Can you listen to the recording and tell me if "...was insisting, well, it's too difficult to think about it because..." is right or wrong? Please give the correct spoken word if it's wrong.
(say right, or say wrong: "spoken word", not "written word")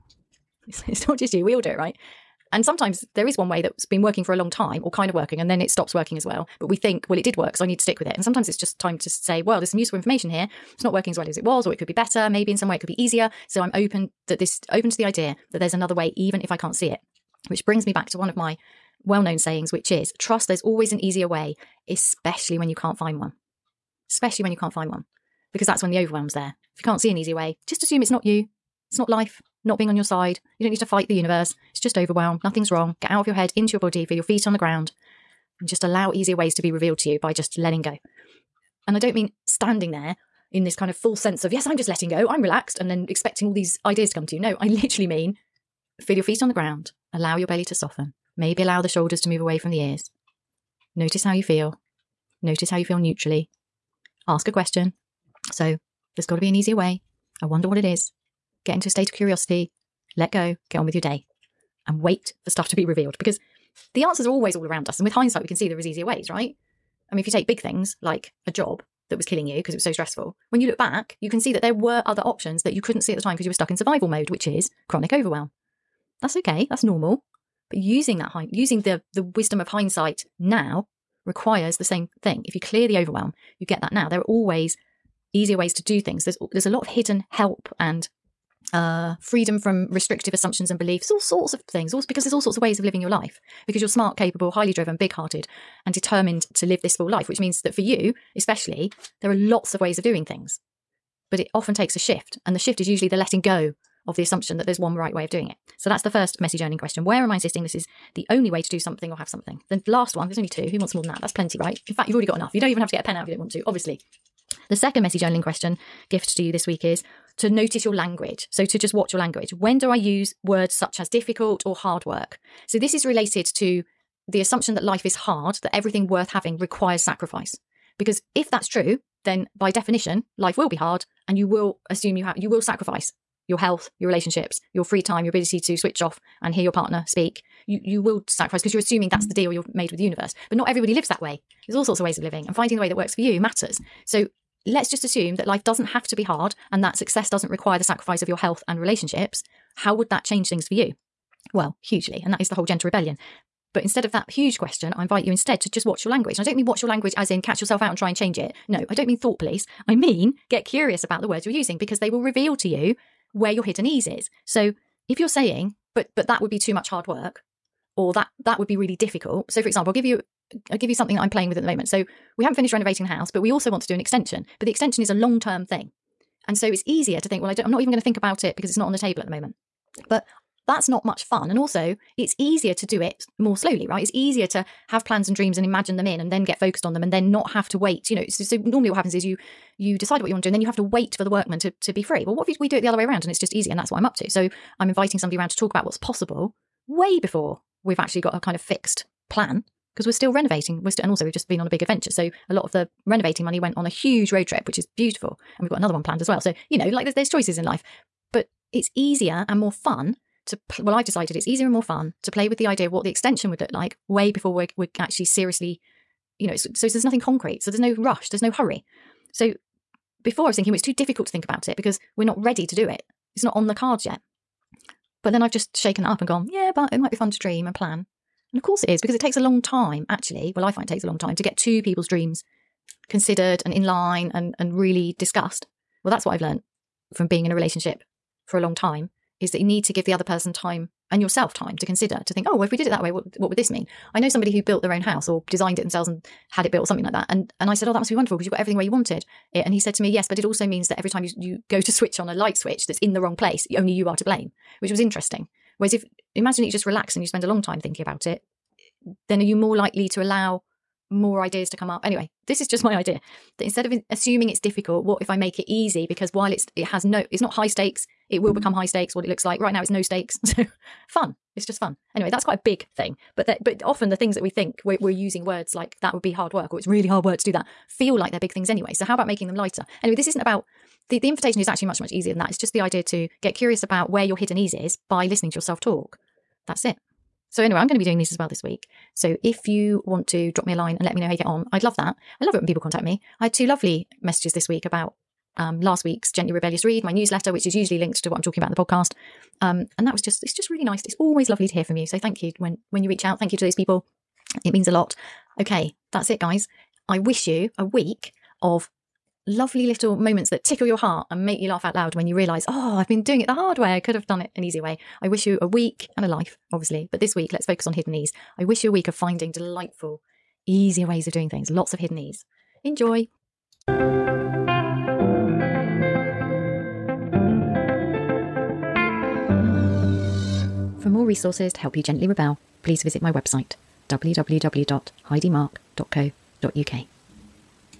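wrong: "thinking", not "insisting".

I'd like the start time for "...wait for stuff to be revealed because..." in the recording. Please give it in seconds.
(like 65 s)
62 s.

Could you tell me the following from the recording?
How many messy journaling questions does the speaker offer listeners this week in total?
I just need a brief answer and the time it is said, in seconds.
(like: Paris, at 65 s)
2, at 110 s.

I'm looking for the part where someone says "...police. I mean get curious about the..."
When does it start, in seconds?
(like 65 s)
159 s.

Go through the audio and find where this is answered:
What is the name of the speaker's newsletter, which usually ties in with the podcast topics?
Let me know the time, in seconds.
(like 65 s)
296 s.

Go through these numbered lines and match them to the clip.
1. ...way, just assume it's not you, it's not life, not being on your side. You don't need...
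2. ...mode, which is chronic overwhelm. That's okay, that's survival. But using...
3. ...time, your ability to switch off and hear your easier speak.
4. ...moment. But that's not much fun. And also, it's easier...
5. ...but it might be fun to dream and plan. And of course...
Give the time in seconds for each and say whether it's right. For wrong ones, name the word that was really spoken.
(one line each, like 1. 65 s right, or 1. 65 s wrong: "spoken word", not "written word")
1. 27 s right
2. 74 s wrong: "normal", not "survival"
3. 135 s wrong: "partner", not "easier"
4. 179 s right
5. 226 s right.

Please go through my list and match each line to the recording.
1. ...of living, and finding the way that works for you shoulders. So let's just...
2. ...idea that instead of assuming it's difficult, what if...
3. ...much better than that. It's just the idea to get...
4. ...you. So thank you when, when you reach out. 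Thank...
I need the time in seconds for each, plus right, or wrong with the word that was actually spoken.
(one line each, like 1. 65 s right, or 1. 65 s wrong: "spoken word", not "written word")
1. 142 s wrong: "matters", not "shoulders"
2. 262 s right
3. 281 s wrong: "easier", not "better"
4. 301 s right.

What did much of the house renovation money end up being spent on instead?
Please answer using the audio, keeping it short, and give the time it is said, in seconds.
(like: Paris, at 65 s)
A huge road trip, at 203 s.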